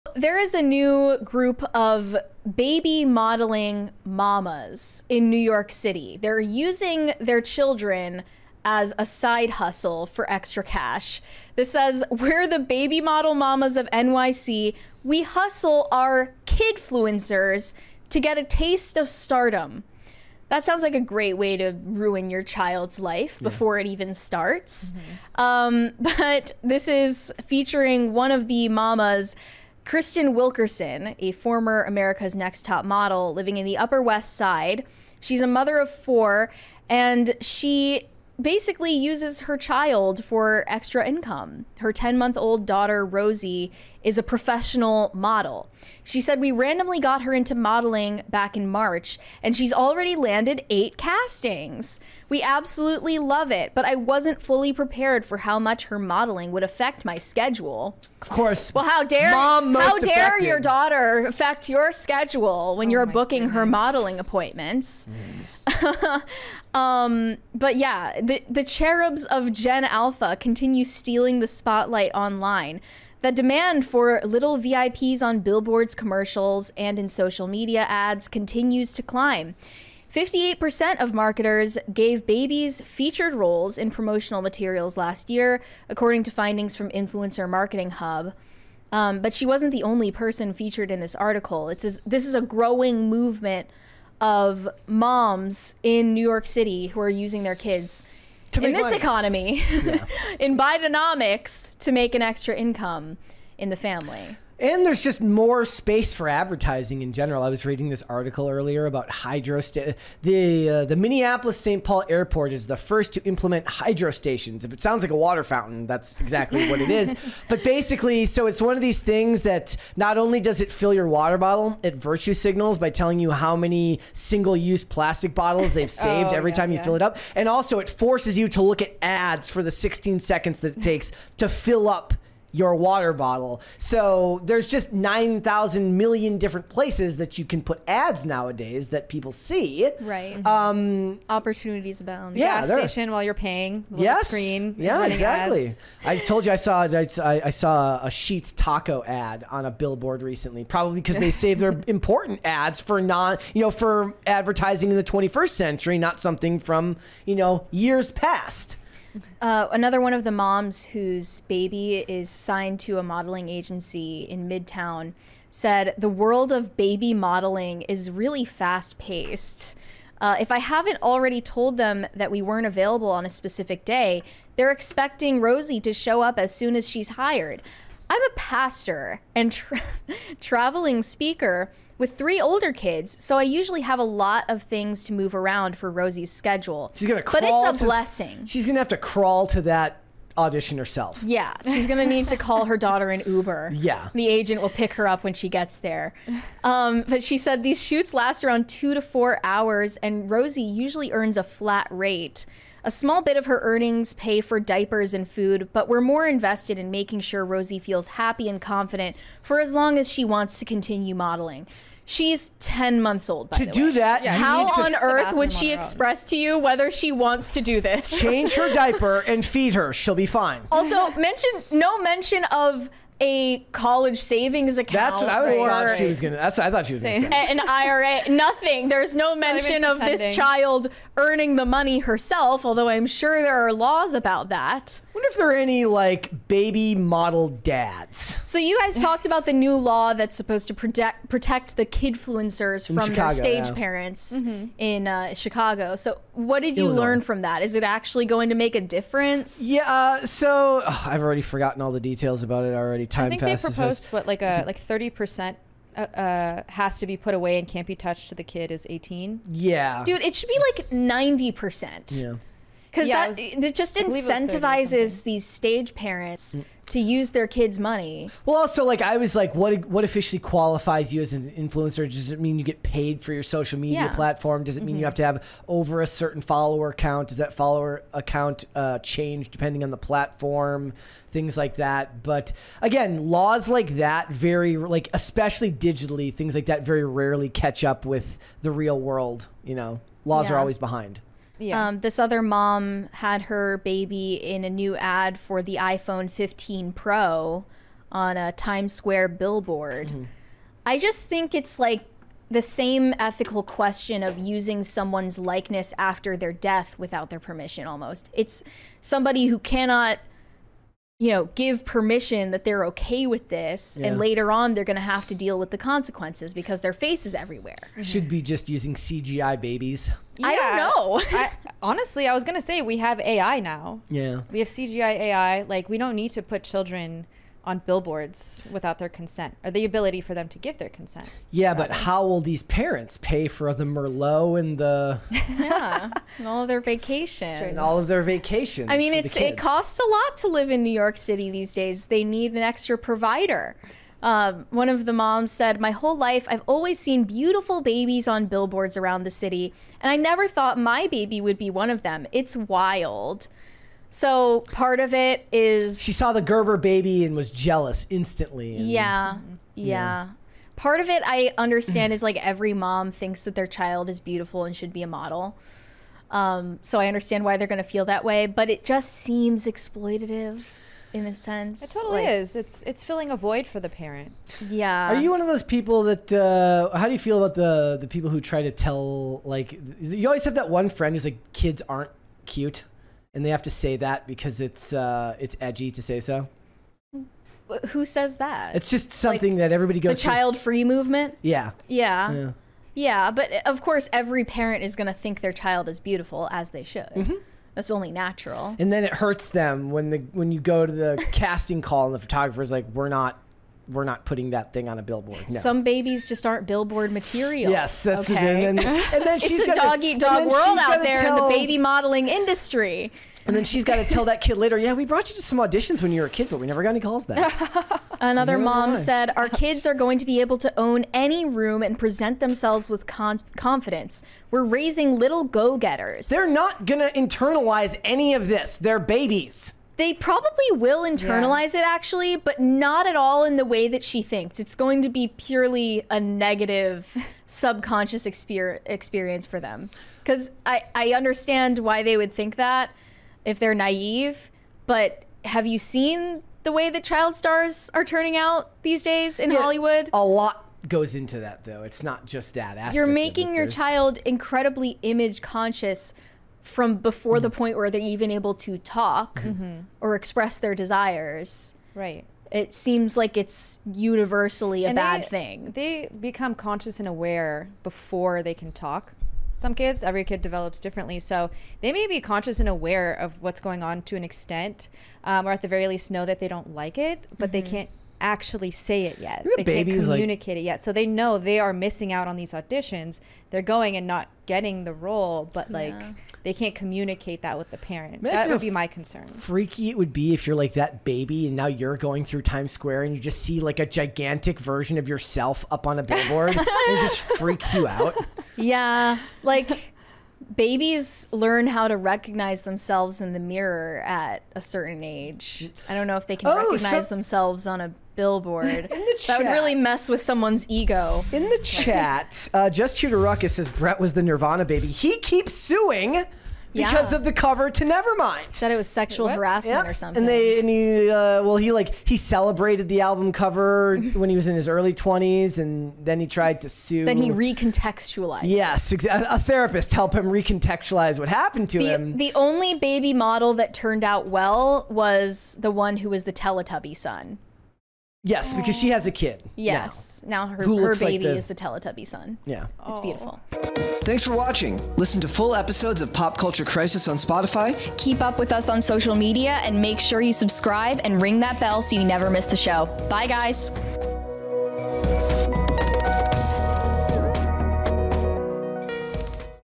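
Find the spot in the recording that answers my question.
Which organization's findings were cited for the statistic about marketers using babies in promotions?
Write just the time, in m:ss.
1:26.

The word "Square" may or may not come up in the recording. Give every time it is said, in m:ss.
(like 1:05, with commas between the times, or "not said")
4:58, 8:12.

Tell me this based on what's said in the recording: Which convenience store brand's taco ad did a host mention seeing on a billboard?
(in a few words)
Sheetz.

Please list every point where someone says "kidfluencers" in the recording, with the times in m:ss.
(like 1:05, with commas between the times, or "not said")
0:16, 4:01.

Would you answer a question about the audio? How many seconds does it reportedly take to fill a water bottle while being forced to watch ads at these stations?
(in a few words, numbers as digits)
16.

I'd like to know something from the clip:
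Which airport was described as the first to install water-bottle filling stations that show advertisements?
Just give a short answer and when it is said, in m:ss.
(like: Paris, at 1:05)
Minneapolis St. Paul Airport, at 1:50.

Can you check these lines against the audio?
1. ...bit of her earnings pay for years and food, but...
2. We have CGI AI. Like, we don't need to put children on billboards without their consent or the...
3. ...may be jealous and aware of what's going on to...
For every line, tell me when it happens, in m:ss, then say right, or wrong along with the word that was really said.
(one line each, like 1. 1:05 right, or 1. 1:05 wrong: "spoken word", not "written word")
1. 3:23 wrong: "diapers", not "years"
2. 5:24 right
3. 7:51 wrong: "conscious", not "jealous".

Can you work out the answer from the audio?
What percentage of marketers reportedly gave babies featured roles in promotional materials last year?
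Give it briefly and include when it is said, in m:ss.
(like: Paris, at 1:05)
58%, at 1:20.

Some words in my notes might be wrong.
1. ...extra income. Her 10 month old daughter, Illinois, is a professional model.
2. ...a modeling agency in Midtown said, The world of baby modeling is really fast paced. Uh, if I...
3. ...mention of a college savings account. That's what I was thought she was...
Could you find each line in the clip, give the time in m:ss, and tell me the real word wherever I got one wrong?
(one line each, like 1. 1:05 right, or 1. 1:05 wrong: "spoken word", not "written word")
1. 0:40 wrong: "Rosie", not "Illinois"
2. 2:42 right
3. 3:41 right.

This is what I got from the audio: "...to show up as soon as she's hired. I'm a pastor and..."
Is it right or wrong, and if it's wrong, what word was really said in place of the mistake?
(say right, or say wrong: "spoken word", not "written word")
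right.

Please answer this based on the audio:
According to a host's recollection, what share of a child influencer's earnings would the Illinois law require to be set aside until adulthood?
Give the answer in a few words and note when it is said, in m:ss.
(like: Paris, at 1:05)
30%, at 4:14.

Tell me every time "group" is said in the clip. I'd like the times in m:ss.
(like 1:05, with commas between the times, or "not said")
0:01.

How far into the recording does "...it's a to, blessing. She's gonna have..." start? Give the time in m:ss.
3:07.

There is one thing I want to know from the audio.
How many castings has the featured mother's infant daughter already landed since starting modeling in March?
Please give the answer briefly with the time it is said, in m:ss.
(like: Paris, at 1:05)
8, at 0:50.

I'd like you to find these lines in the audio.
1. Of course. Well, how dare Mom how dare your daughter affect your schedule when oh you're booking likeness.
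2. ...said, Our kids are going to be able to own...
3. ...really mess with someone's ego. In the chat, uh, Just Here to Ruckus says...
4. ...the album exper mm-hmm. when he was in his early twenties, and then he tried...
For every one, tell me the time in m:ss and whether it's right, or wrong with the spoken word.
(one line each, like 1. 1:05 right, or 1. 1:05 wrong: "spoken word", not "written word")
1. 0:58 wrong: "goodness", not "likeness"
2. 6:58 right
3. 8:29 right
4. 8:42 wrong: "cover", not "exper".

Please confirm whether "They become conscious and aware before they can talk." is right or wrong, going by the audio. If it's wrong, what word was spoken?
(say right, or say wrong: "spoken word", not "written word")
right.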